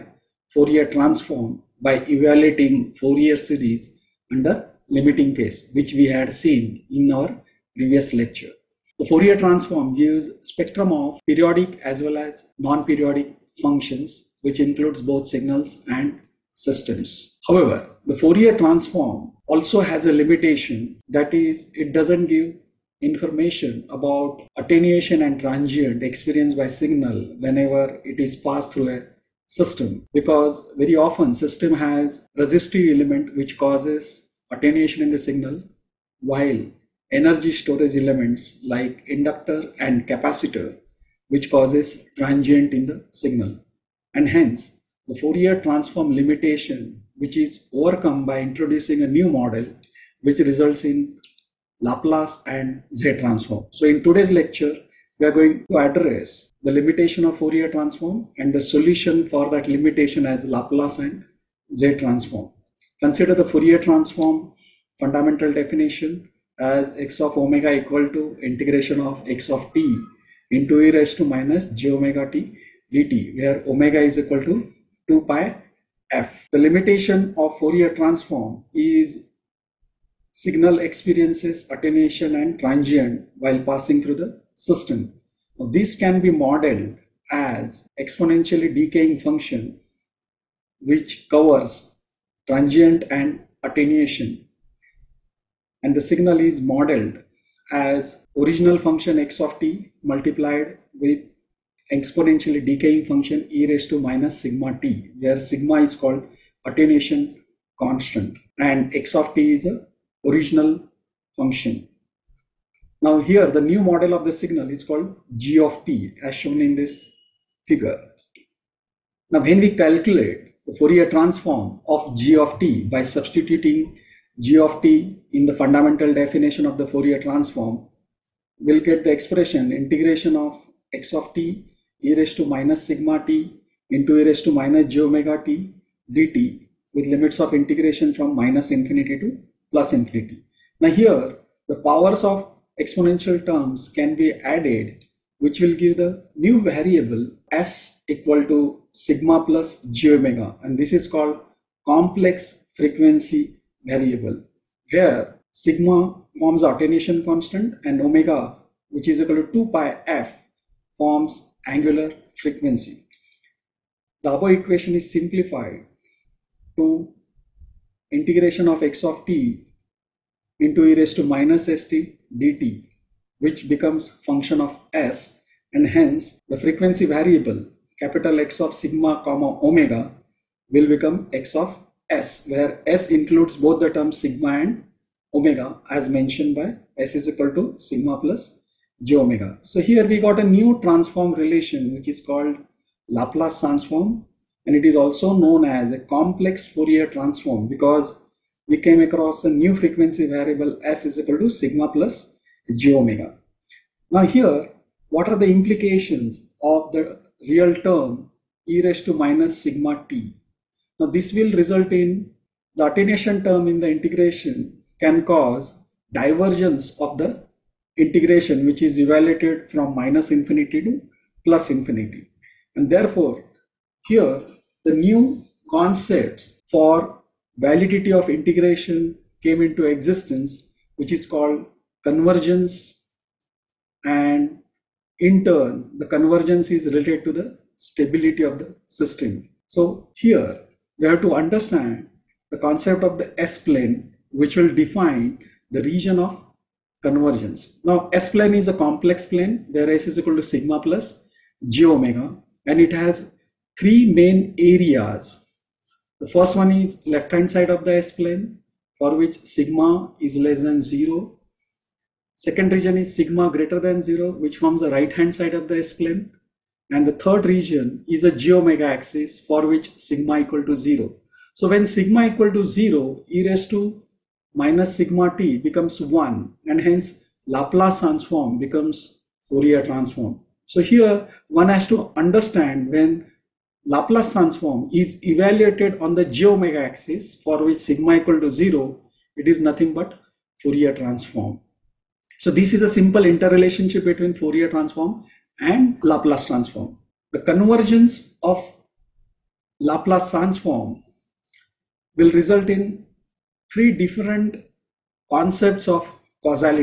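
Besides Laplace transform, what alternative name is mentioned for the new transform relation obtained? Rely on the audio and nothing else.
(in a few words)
complex Fourier transform.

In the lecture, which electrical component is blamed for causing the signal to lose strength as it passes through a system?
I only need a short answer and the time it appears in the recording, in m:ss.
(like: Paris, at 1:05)
resistive element, at 0:32.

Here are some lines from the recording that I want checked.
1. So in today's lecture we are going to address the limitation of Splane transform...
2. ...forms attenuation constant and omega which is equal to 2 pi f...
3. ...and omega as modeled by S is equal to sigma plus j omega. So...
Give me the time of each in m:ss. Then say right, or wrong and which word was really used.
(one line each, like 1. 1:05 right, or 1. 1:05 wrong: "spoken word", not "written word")
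1. 0:53 wrong: "Fourier", not "Splane"
2. 2:36 right
3. 3:04 wrong: "mentioned", not "modeled".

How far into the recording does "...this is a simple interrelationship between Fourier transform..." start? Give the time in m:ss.
4:52.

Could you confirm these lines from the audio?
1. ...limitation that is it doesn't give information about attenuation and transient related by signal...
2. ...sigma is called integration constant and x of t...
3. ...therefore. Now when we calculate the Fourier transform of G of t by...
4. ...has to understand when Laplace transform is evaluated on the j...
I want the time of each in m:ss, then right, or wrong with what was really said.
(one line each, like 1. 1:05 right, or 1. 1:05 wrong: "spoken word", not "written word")
1. 0:20 wrong: "experienced", not "related"
2. 1:45 wrong: "attenuation", not "integration"
3. 1:57 wrong: "figure", not "therefore"
4. 4:41 right.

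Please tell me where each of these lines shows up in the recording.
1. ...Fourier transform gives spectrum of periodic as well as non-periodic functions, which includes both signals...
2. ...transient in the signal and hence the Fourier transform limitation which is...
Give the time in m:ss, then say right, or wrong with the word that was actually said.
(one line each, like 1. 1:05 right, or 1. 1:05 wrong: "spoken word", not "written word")
1. 0:09 right
2. 0:42 right.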